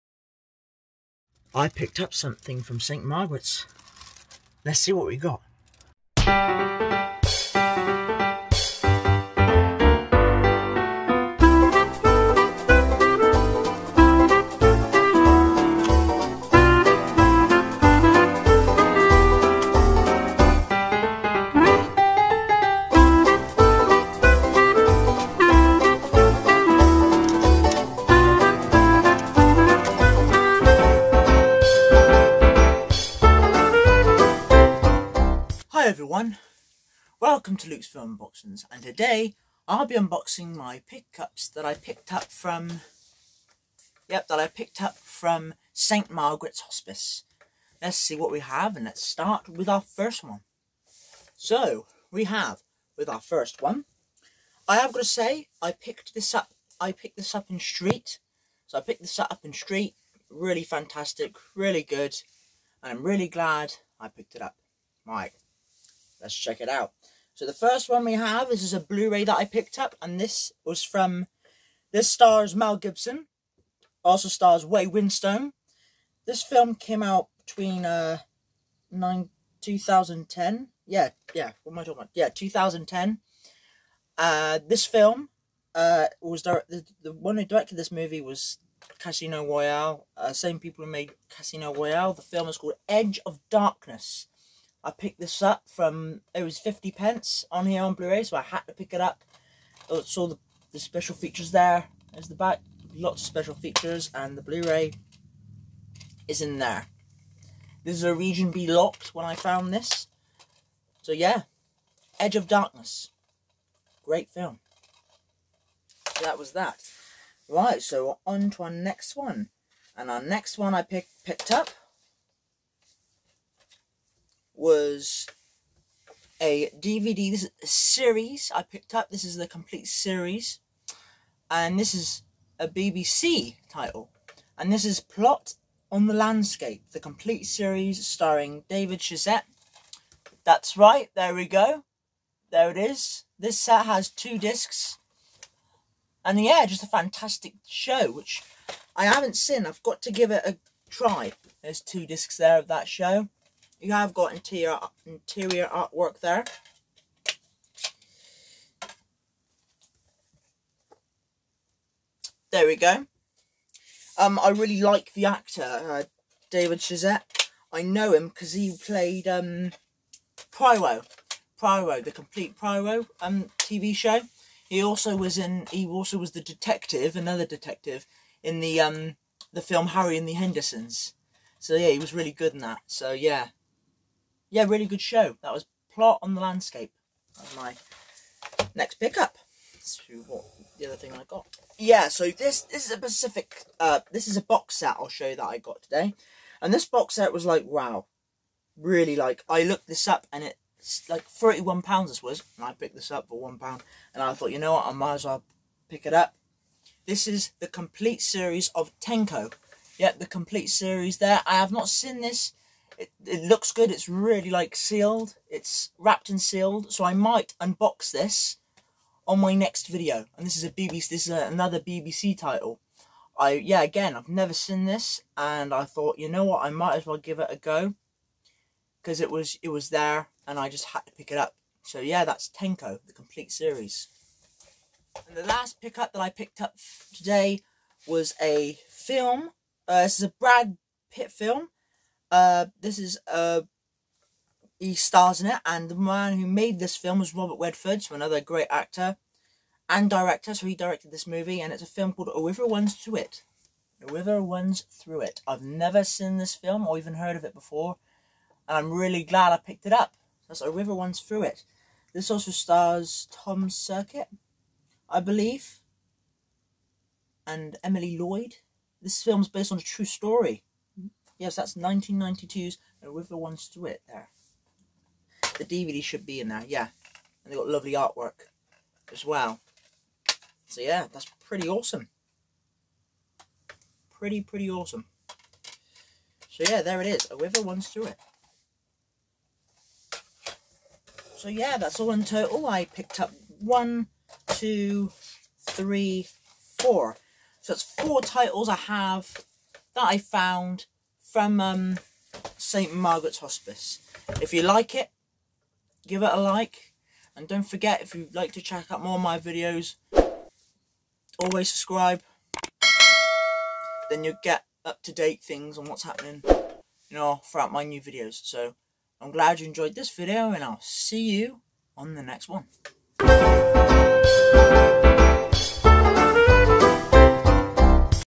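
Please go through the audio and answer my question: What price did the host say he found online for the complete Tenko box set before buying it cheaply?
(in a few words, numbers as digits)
31 pounds.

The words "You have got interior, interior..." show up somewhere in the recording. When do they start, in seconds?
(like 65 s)
153 s.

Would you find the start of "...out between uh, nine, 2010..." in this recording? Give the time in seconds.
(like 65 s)
77 s.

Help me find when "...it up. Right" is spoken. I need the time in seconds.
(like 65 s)
64 s.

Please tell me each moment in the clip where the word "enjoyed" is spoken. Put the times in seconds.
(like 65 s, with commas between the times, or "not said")
319 s.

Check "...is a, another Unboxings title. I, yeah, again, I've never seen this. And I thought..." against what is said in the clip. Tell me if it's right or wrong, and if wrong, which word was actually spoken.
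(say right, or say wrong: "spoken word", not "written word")
wrong: "BBC", not "Unboxings".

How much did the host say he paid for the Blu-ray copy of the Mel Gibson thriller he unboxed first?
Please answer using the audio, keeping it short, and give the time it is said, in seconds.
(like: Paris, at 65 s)
50 pence, at 96 s.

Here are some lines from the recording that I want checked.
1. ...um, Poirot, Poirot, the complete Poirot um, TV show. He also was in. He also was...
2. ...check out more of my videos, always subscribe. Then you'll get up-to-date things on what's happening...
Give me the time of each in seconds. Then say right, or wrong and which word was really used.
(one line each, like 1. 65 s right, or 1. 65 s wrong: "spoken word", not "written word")
1. 169 s right
2. 308 s right.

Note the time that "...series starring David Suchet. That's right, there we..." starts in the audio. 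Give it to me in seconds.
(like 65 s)
137 s.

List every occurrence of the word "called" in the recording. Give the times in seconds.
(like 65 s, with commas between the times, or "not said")
92 s, 252 s.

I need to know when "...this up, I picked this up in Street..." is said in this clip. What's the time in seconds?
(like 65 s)
56 s.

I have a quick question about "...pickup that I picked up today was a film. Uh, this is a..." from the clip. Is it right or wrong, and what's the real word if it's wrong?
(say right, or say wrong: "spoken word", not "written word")
right.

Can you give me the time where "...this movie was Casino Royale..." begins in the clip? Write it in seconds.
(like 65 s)
87 s.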